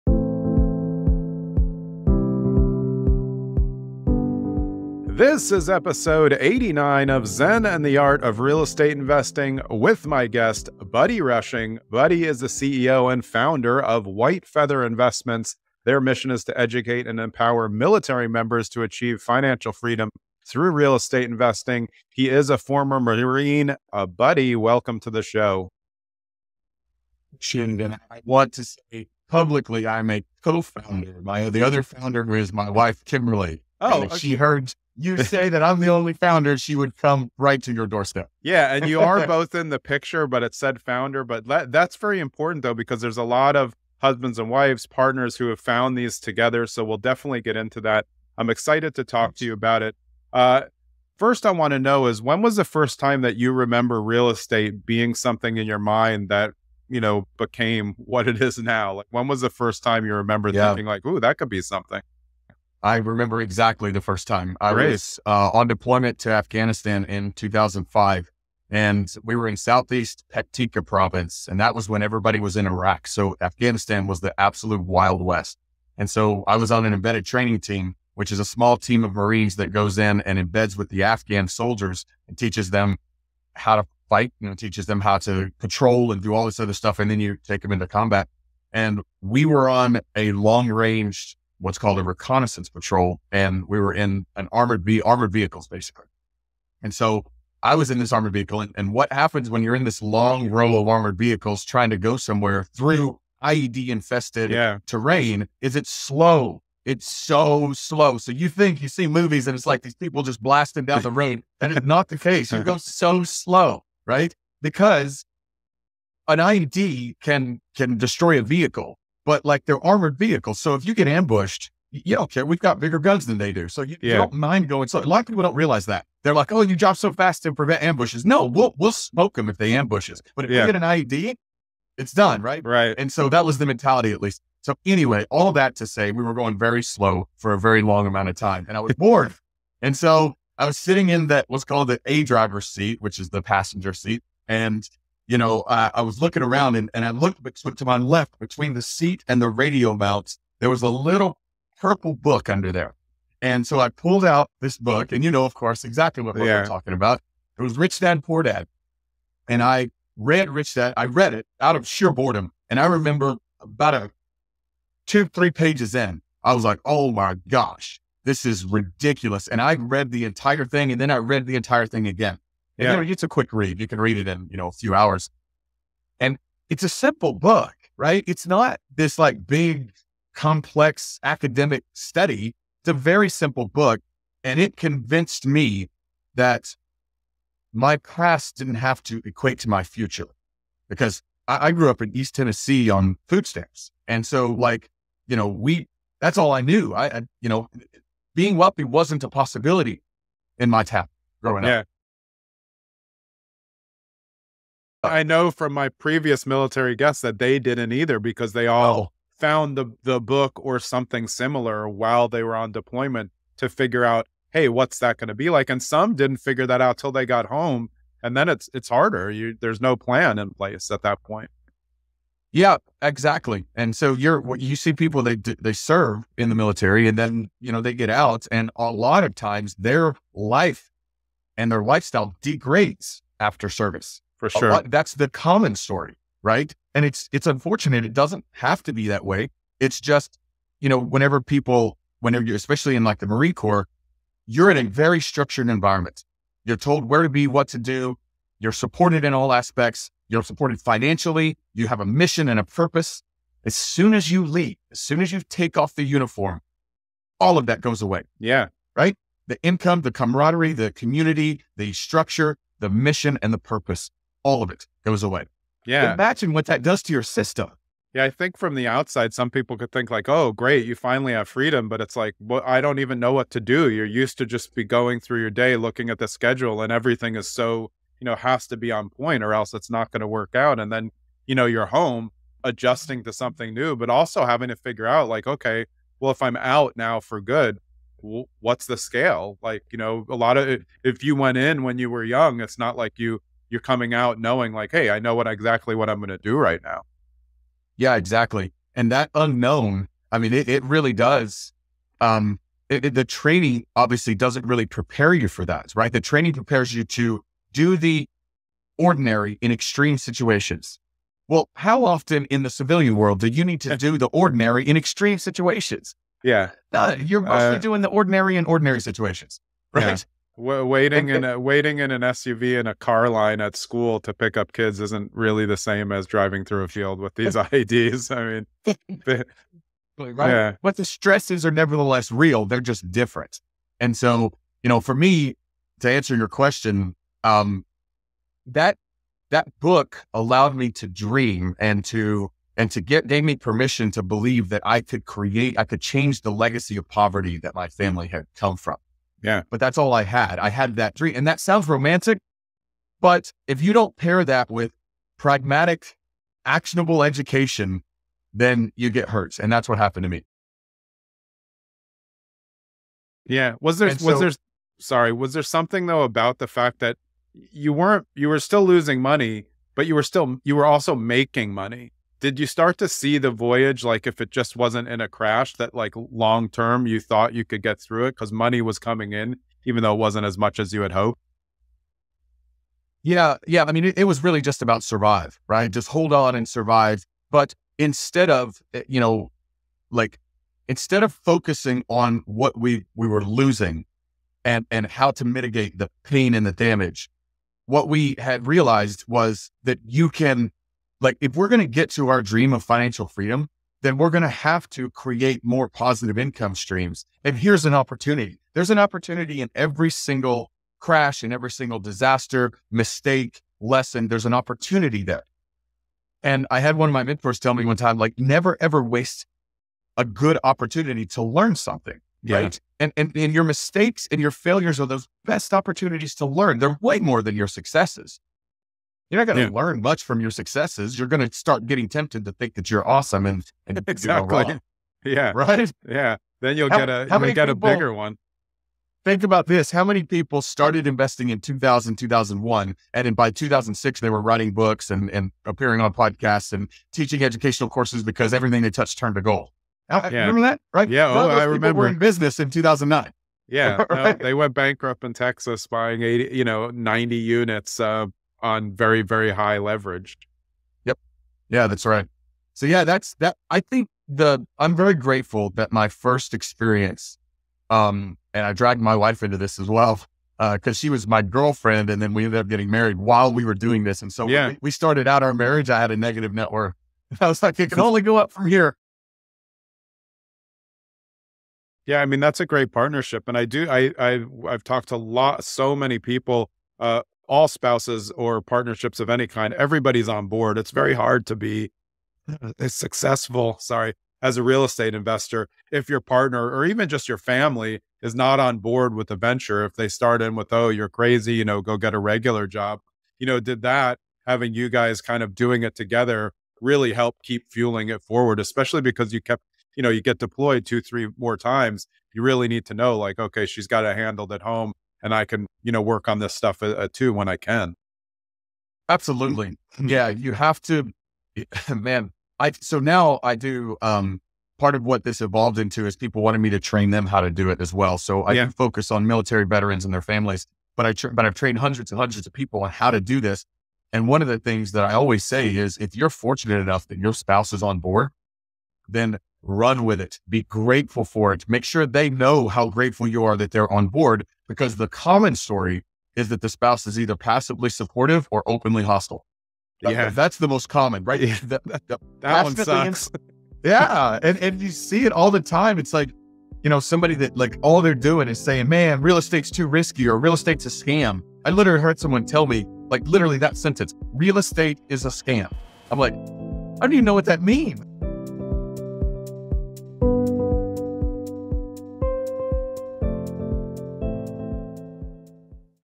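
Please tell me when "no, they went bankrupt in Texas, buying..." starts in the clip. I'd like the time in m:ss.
7:34.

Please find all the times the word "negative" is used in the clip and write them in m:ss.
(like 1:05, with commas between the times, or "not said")
7:56.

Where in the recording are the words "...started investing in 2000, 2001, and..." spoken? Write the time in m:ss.
7:20.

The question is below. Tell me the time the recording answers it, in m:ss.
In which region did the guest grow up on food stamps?
3:12.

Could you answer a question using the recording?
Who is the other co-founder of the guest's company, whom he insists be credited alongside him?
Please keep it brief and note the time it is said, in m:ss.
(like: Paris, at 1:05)
Kimberly, at 0:33.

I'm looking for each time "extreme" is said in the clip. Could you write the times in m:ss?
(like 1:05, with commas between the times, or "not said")
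5:09, 5:14.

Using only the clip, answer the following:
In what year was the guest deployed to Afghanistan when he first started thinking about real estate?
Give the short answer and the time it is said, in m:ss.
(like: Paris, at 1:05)
2005, at 1:07.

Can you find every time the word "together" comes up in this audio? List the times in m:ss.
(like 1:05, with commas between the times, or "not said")
0:46, 8:25.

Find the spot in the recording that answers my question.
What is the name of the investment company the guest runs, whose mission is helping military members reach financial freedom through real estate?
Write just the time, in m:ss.
0:14.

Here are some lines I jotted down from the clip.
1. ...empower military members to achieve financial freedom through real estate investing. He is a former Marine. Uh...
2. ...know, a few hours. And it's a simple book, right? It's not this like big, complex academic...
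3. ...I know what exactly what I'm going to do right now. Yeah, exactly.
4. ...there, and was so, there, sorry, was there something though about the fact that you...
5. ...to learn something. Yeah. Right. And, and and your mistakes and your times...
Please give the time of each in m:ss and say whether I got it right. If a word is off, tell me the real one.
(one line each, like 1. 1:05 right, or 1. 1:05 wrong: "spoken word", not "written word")
1. 0:17 right
2. 2:54 right
3. 4:55 right
4. 6:03 right
5. 7:01 wrong: "failures", not "times".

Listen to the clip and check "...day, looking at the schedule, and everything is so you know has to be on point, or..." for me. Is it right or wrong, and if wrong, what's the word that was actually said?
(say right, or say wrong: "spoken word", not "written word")
right.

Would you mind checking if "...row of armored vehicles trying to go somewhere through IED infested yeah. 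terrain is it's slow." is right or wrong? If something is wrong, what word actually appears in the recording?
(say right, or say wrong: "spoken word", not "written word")
right.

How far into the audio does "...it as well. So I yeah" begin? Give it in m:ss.
8:47.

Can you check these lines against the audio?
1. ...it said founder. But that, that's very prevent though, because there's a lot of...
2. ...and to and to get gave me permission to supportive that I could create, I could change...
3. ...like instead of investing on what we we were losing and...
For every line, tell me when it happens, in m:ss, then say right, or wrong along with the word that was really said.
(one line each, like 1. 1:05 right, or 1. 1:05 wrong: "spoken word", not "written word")
1. 0:40 wrong: "important", not "prevent"
2. 5:41 wrong: "believe", not "supportive"
3. 6:30 wrong: "focusing", not "investing".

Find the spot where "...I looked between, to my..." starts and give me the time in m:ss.
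2:27.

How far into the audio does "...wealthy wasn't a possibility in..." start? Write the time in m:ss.
3:18.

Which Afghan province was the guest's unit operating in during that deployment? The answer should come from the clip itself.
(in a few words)
Paktika.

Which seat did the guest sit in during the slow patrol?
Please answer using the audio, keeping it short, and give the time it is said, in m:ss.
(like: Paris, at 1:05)
A driver's seat, at 2:22.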